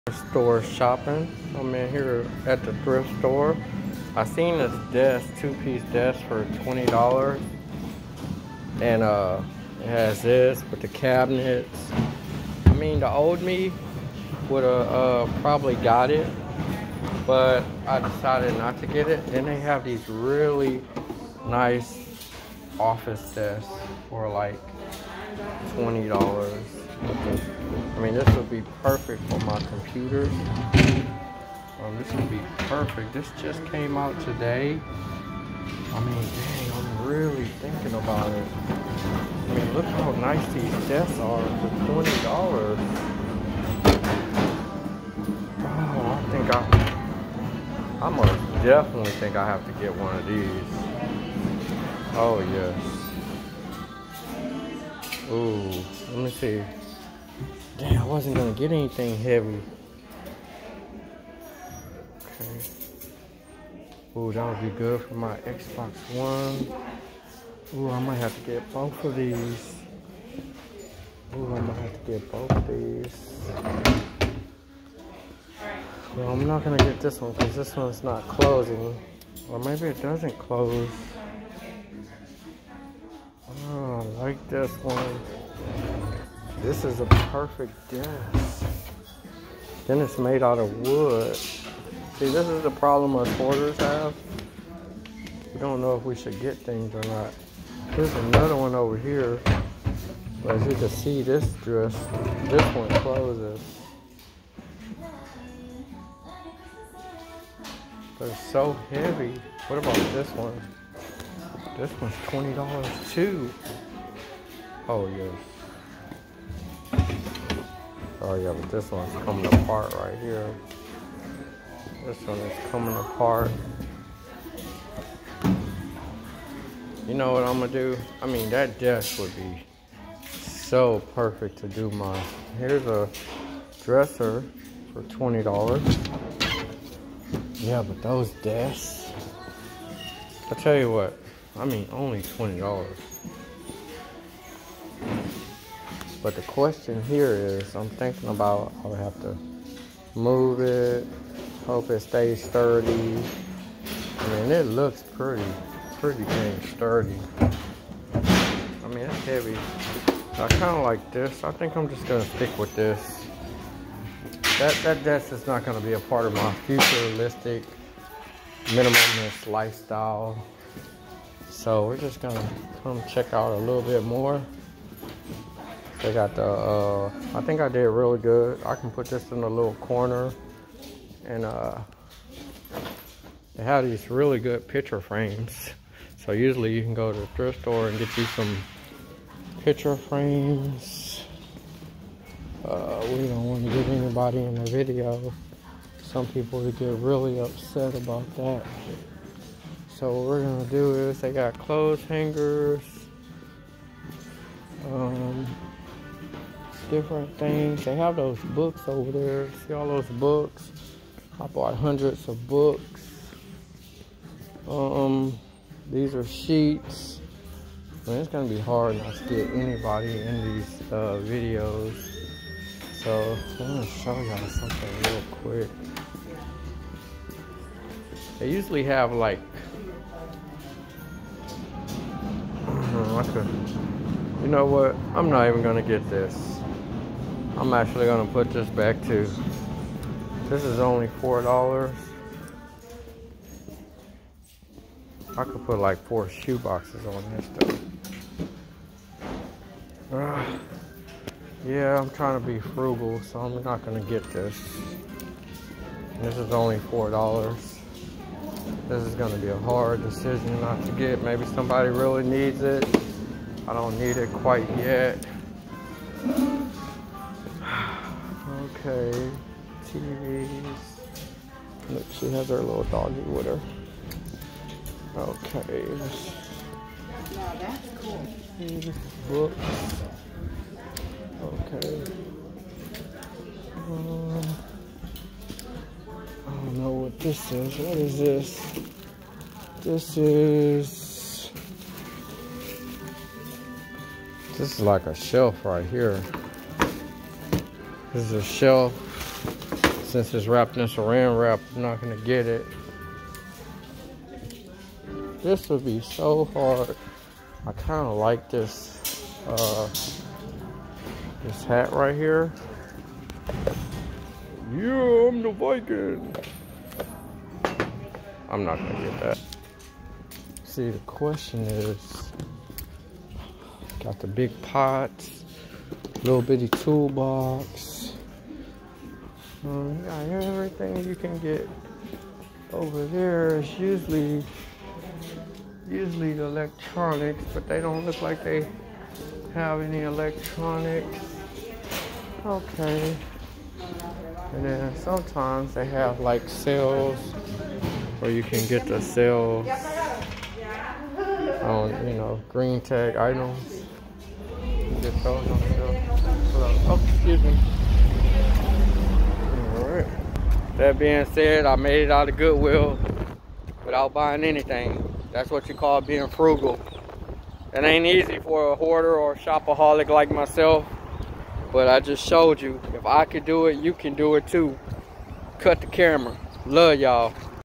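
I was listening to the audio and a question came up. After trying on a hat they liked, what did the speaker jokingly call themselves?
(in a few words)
The Viking.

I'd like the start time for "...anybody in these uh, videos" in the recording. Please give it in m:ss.
3:39.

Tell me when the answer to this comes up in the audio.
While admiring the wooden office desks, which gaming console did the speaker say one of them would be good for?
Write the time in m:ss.
1:05.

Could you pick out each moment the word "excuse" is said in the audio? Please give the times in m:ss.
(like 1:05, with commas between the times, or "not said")
5:57.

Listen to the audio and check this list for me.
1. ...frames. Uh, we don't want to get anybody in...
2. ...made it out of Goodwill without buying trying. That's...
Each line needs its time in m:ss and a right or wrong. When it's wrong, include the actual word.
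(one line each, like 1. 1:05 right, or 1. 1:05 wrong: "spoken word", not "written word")
1. 3:09 right
2. 6:01 wrong: "anything", not "trying".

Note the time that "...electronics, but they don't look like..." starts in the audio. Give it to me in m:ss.
5:36.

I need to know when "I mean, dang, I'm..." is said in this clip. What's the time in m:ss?
0:35.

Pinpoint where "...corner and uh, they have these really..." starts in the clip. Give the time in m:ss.
2:59.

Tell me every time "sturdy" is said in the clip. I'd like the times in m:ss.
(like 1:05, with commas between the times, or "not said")
2:32, 2:36.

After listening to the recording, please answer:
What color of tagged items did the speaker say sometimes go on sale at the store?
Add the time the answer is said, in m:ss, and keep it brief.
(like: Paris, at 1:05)
Green, at 5:52.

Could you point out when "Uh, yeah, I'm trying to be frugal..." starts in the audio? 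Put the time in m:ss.
4:10.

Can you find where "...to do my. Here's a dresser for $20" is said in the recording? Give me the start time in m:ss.
2:11.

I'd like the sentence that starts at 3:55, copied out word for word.
I'm not even gonna get this.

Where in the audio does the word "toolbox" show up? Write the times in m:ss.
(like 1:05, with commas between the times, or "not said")
5:26.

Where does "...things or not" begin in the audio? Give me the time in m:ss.
1:36.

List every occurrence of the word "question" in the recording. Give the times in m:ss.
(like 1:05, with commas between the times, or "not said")
2:26, 5:20.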